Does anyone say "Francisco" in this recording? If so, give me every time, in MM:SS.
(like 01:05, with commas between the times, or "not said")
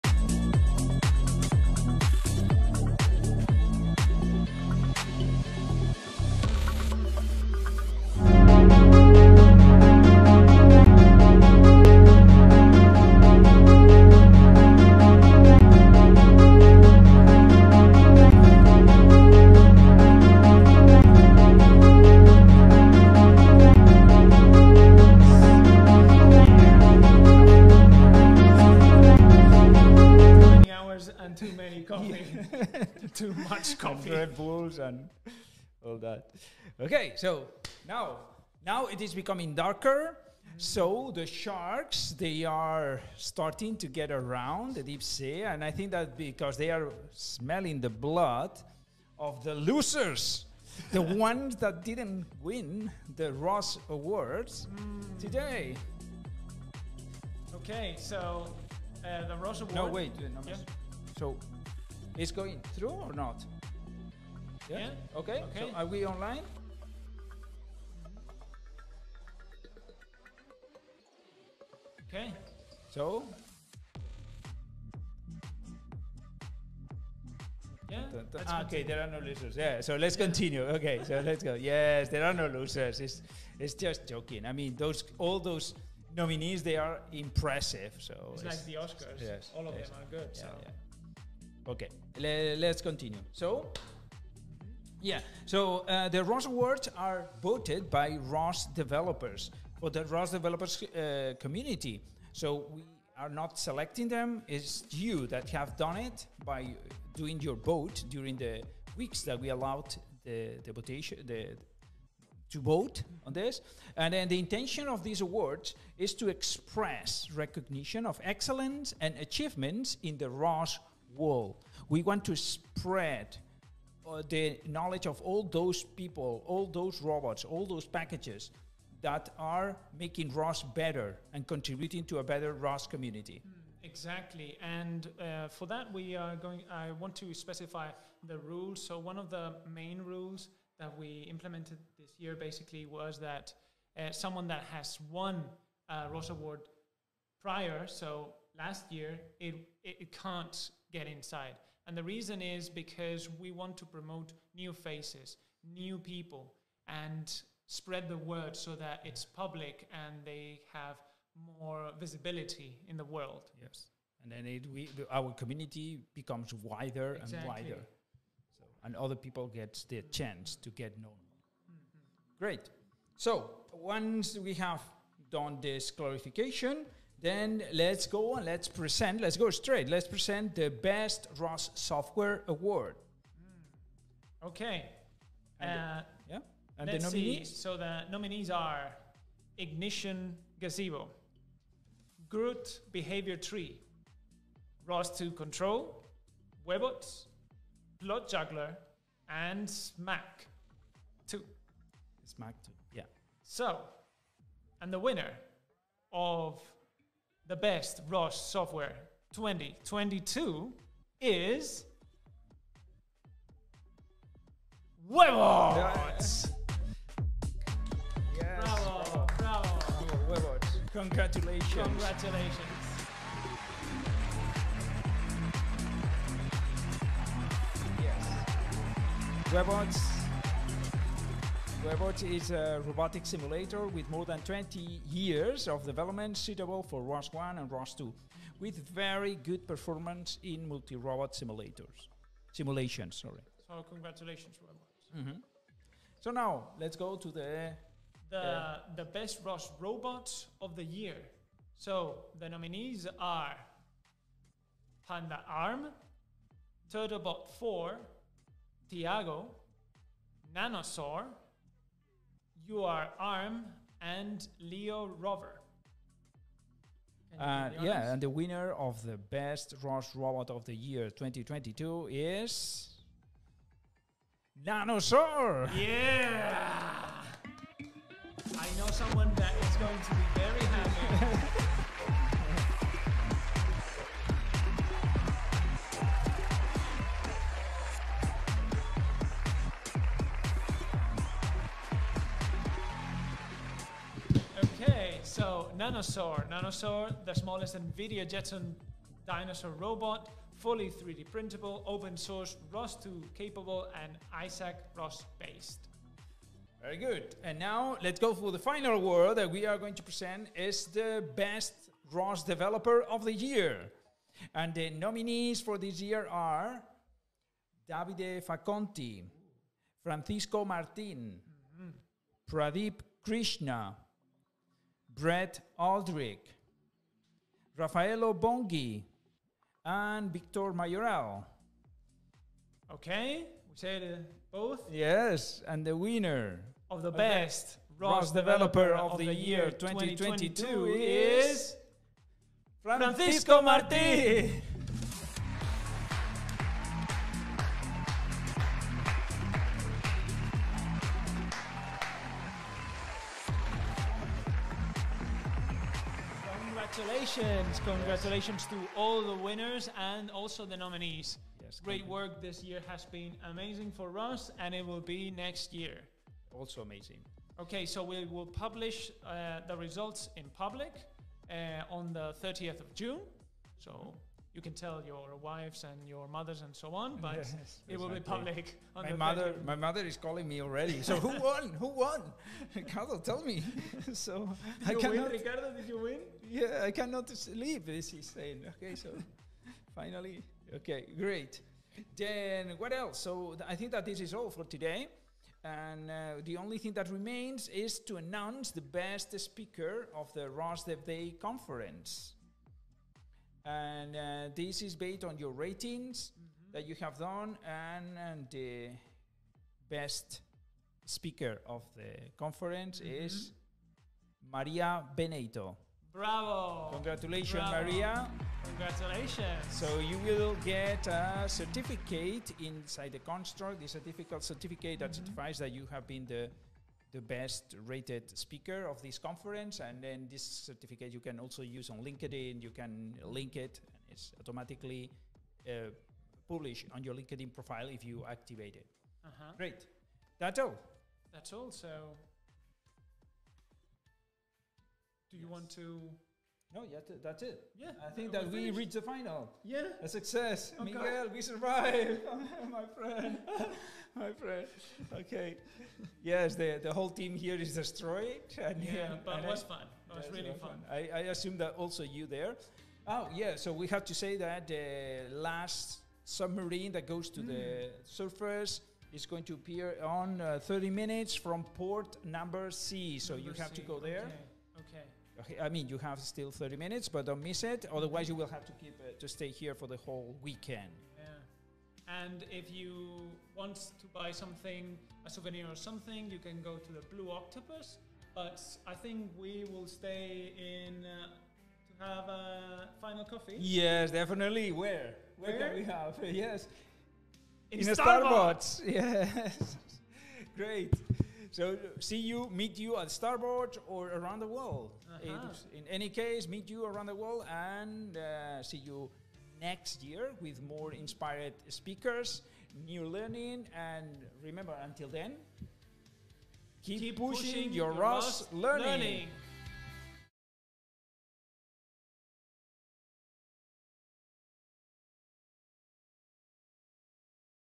05:20, 05:42.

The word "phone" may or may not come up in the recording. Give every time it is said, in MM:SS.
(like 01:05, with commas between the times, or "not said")
not said.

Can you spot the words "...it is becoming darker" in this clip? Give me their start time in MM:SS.
00:38.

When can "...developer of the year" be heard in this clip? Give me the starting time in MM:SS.
05:12.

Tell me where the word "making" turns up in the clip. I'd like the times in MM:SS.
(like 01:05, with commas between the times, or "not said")
02:09.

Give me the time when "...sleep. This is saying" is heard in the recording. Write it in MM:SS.
06:27.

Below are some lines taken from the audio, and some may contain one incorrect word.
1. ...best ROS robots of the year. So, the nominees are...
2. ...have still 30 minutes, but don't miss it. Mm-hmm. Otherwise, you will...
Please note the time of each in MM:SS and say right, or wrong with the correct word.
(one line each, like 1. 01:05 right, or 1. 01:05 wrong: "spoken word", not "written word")
1. 04:09 right
2. 07:55 right.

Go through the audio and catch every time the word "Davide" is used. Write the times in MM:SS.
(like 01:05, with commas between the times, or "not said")
05:17.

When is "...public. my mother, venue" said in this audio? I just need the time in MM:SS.
06:18.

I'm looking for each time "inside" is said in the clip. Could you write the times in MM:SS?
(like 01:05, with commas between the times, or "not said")
02:31, 07:02.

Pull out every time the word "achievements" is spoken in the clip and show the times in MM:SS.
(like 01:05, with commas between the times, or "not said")
01:59.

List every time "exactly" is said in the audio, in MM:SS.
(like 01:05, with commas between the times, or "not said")
02:13, 02:47.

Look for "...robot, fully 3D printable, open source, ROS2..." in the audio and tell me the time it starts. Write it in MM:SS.
04:59.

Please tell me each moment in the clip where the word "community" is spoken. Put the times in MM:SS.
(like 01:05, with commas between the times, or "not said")
01:41, 02:12, 02:45.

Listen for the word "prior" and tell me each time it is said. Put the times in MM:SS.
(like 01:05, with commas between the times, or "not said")
02:27.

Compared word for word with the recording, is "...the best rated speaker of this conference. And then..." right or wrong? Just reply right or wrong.
right.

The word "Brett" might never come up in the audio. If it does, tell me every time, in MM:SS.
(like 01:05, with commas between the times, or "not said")
05:25.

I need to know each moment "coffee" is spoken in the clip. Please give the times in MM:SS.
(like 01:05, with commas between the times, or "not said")
00:33, 08:13.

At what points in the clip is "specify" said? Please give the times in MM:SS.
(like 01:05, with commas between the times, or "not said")
02:17.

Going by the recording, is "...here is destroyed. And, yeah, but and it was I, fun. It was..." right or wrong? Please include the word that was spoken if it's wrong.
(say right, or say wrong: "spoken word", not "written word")
right.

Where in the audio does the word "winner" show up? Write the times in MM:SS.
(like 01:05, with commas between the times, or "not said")
03:24, 04:28, 05:35, 05:59.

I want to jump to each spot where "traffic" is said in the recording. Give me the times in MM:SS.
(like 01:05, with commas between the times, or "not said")
not said.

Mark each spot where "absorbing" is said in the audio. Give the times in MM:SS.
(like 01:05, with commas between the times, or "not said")
not said.